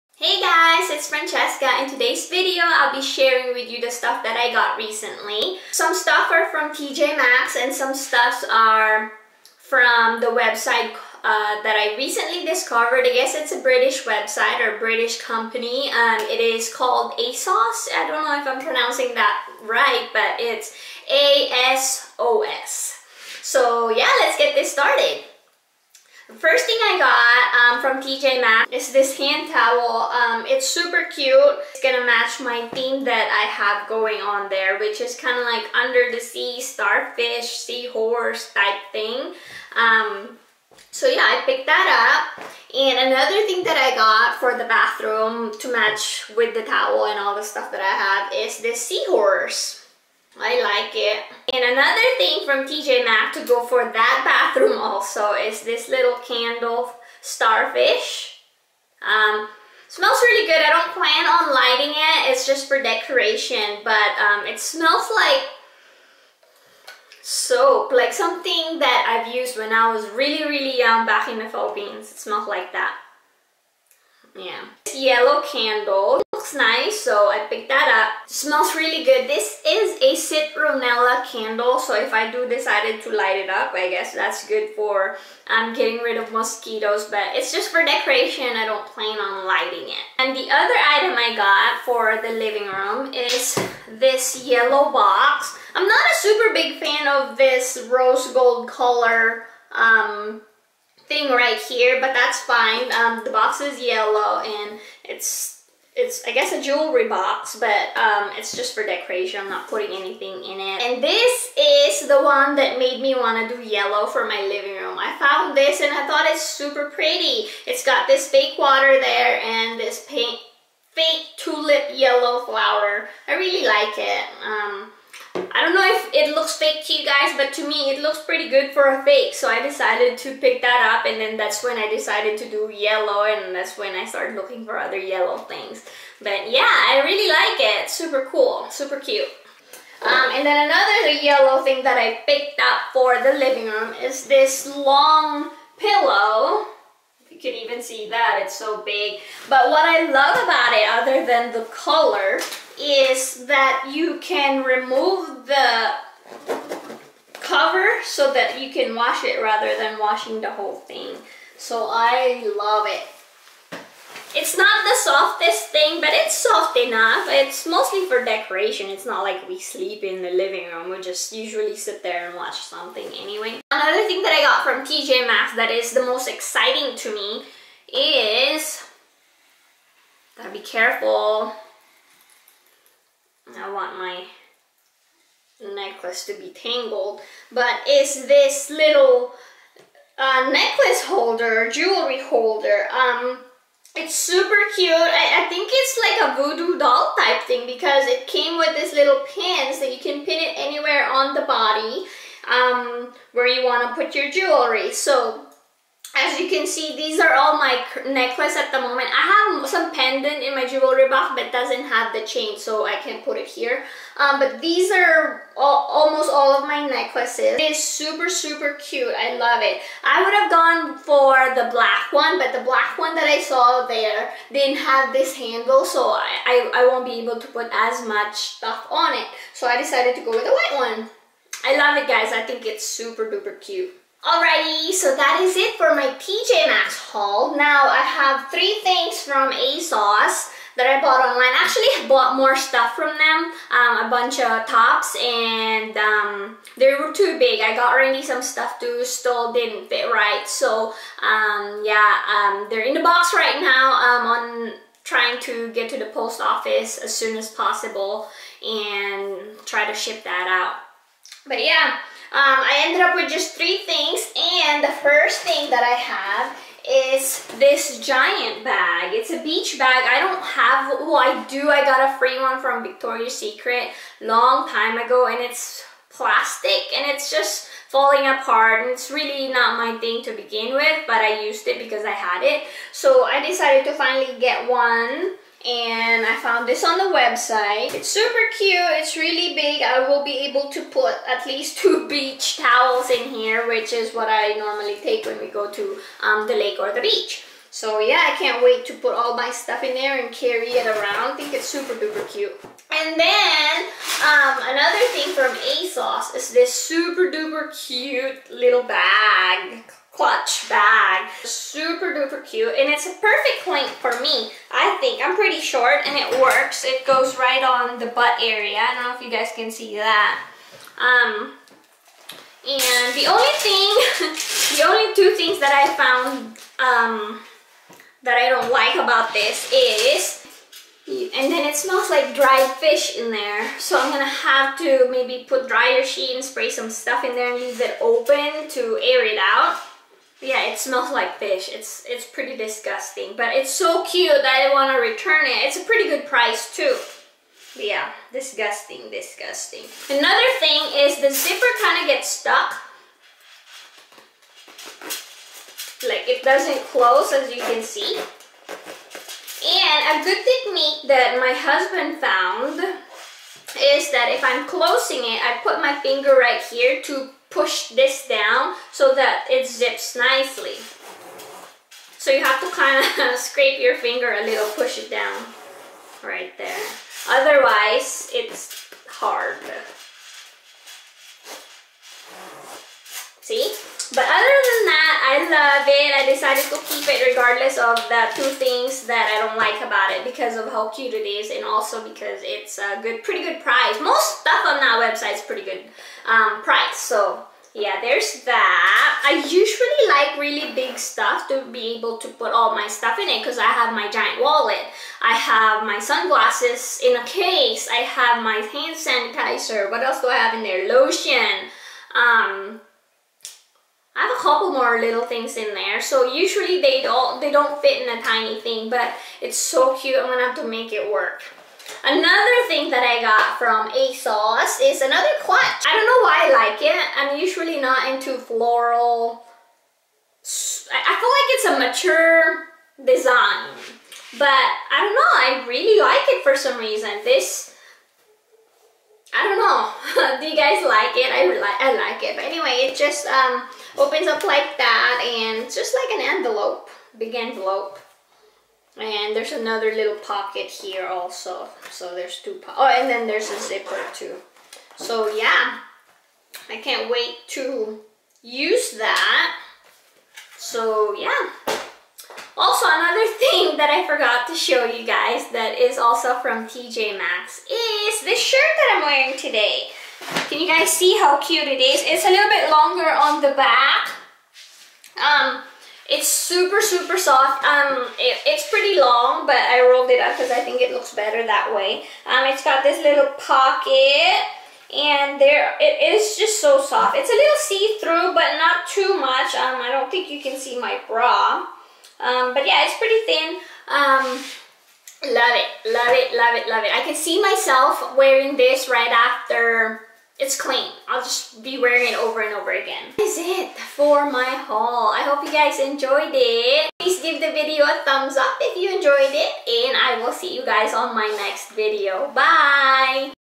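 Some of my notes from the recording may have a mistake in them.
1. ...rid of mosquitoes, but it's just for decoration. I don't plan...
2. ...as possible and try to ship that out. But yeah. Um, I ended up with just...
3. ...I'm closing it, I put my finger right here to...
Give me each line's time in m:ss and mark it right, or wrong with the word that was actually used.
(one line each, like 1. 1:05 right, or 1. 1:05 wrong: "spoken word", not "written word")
1. 1:25 right
2. 4:17 right
3. 6:04 right.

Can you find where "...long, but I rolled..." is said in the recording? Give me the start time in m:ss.
7:58.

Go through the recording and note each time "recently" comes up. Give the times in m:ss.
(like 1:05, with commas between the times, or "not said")
0:04, 0:11.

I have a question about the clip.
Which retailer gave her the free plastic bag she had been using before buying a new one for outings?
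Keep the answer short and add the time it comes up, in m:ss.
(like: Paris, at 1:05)
Victoria's Secret, at 4:32.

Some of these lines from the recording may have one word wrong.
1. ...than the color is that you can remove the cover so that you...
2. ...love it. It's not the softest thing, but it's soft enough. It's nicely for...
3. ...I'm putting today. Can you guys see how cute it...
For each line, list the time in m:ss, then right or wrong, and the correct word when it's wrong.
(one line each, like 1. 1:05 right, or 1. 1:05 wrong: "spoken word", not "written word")
1. 2:31 right
2. 2:42 wrong: "mostly", not "nicely"
3. 7:48 wrong: "wearing", not "putting".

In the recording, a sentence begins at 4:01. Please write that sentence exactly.
Actually, I bought more stuff from them.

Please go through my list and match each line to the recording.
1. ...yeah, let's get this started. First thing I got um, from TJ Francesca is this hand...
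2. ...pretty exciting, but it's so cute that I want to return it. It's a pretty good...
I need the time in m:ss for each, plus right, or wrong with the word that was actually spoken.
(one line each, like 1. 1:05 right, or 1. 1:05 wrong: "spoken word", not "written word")
1. 0:23 wrong: "Maxx", not "Francesca"
2. 5:42 wrong: "disgusting", not "exciting".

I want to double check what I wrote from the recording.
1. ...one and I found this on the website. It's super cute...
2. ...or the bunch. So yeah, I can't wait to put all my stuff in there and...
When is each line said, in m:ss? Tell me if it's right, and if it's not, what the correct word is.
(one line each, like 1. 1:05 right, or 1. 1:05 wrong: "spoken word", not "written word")
1. 4:44 right
2. 4:56 wrong: "beach", not "bunch".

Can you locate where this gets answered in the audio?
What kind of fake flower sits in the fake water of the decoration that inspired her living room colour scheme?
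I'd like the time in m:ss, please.
2:01.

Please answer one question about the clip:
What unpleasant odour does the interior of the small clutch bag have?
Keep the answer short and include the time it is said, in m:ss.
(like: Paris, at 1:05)
Dried fish, at 5:32.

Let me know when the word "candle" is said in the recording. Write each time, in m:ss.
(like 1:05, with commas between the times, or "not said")
0:56, 1:15, 1:21.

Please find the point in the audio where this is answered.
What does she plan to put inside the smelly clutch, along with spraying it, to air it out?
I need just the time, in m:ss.
5:35.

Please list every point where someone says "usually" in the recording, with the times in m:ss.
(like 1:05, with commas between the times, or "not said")
2:51, 6:39, 6:56, 7:07.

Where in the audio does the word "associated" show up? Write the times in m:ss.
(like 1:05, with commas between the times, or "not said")
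not said.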